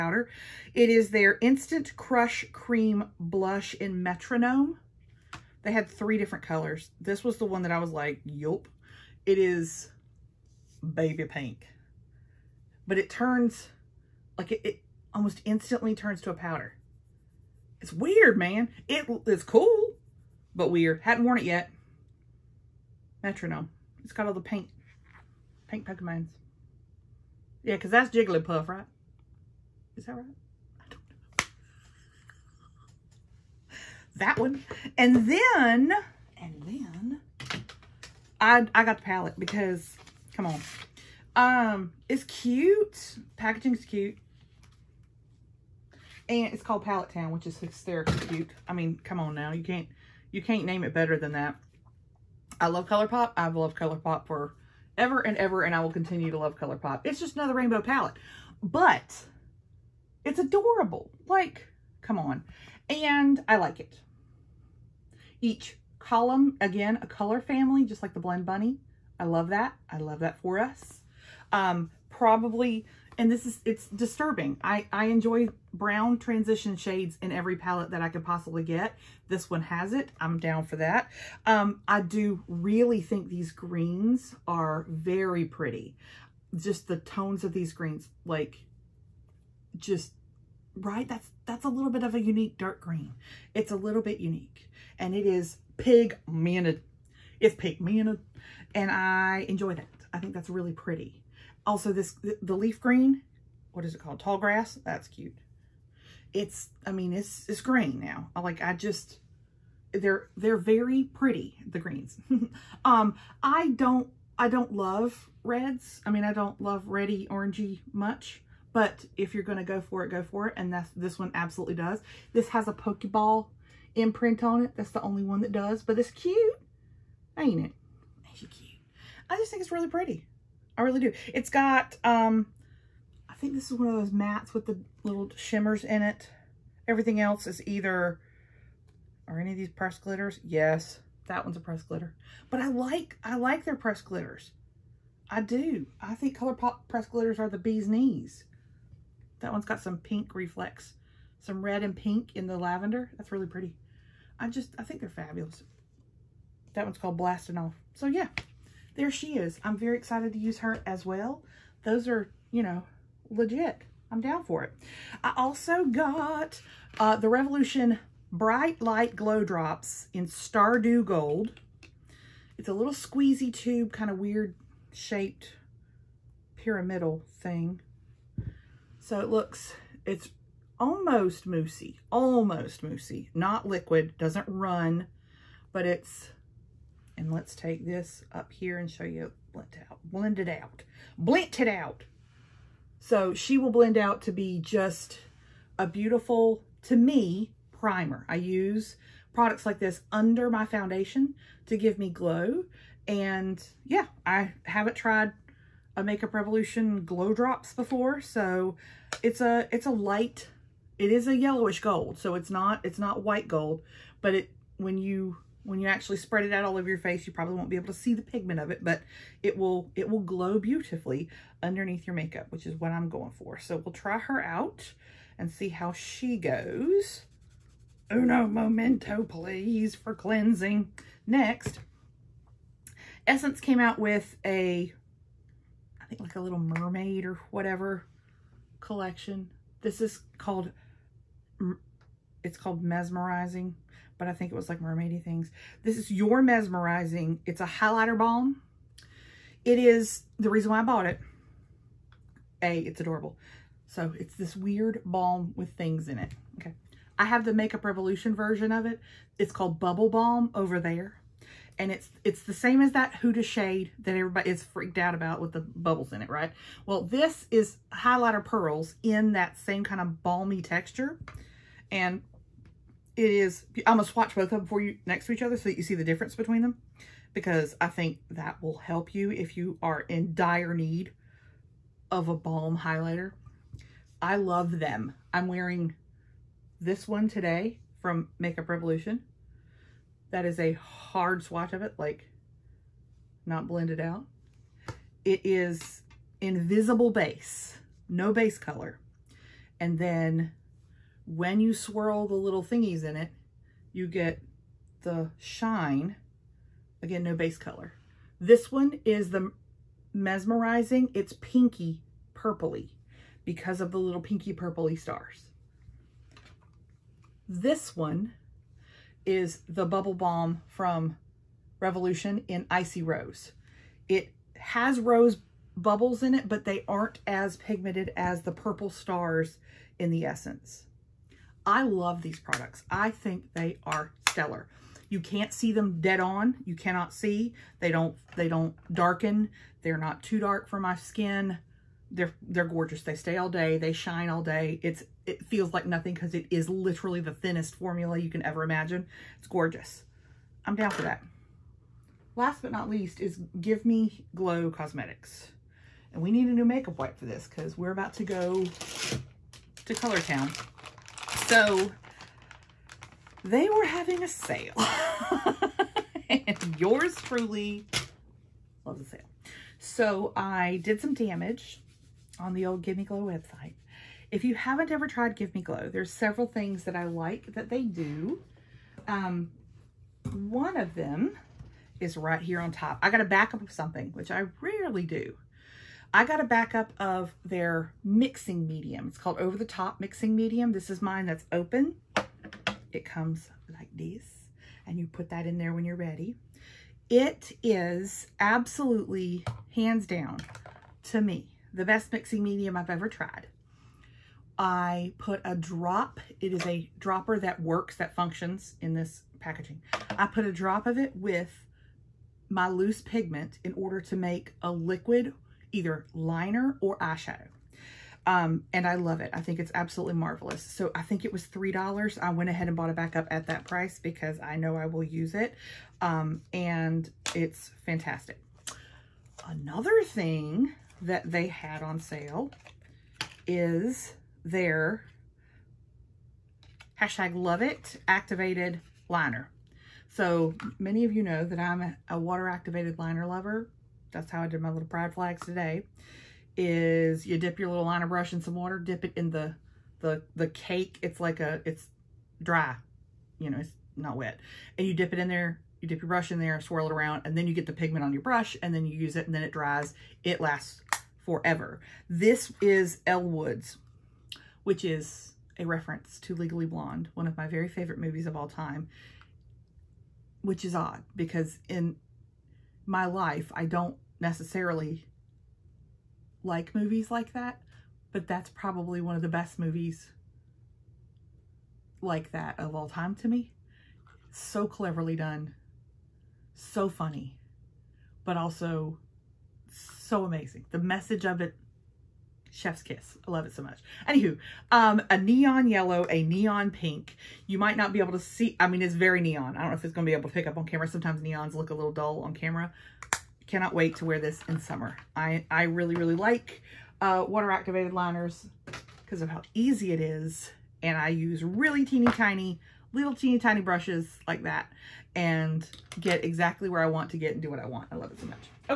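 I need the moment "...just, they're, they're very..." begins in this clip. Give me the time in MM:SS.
01:48.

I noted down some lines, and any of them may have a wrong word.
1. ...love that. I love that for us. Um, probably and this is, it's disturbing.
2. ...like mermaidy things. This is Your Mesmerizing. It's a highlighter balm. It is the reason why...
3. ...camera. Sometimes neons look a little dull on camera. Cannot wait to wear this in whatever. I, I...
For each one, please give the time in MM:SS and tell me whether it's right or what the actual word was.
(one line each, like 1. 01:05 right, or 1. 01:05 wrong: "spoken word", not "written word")
1. 01:09 right
2. 04:04 right
3. 08:20 wrong: "summer", not "whatever".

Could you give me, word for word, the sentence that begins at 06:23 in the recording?
I got to back up of something, which I rarely do.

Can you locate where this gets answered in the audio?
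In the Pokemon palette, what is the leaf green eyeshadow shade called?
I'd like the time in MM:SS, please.
01:44.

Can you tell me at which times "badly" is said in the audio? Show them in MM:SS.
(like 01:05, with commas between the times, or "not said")
not said.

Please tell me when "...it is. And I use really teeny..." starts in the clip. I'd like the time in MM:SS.
08:29.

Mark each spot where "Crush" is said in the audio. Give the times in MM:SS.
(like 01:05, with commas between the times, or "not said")
00:01.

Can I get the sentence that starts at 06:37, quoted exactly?
It is absolutely, hands down, to me, the best mixing medium I've ever tried.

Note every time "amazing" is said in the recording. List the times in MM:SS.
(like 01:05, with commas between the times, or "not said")
08:10.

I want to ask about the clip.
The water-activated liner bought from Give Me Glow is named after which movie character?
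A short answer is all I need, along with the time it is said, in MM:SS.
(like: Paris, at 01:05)
Elle Woods, at 07:43.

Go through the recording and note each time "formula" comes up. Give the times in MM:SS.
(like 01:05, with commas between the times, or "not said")
05:47.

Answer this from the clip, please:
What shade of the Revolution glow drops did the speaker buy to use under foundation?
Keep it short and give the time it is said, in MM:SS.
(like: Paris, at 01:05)
Stardew Gold, at 02:50.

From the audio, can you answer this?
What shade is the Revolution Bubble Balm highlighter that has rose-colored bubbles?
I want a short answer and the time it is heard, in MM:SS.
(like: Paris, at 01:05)
Icy Rose, at 05:22.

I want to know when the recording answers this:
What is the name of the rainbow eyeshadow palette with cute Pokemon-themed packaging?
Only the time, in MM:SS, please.
00:46.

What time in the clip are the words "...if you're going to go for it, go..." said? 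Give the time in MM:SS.
01:59.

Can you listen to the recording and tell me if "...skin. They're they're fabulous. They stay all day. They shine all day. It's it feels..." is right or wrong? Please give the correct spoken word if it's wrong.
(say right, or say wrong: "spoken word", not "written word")
wrong: "gorgeous", not "fabulous".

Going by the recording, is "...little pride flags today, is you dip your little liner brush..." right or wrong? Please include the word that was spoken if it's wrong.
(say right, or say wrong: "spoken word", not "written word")
right.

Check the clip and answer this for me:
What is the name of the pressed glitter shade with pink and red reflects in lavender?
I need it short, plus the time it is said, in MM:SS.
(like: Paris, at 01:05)
Blasting Off, at 02:37.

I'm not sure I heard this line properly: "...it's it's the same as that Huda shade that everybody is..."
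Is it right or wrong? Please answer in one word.
right.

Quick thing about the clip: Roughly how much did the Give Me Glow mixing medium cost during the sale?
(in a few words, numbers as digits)
$3.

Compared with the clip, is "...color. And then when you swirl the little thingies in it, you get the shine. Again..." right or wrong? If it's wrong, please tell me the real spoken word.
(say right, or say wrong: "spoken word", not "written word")
right.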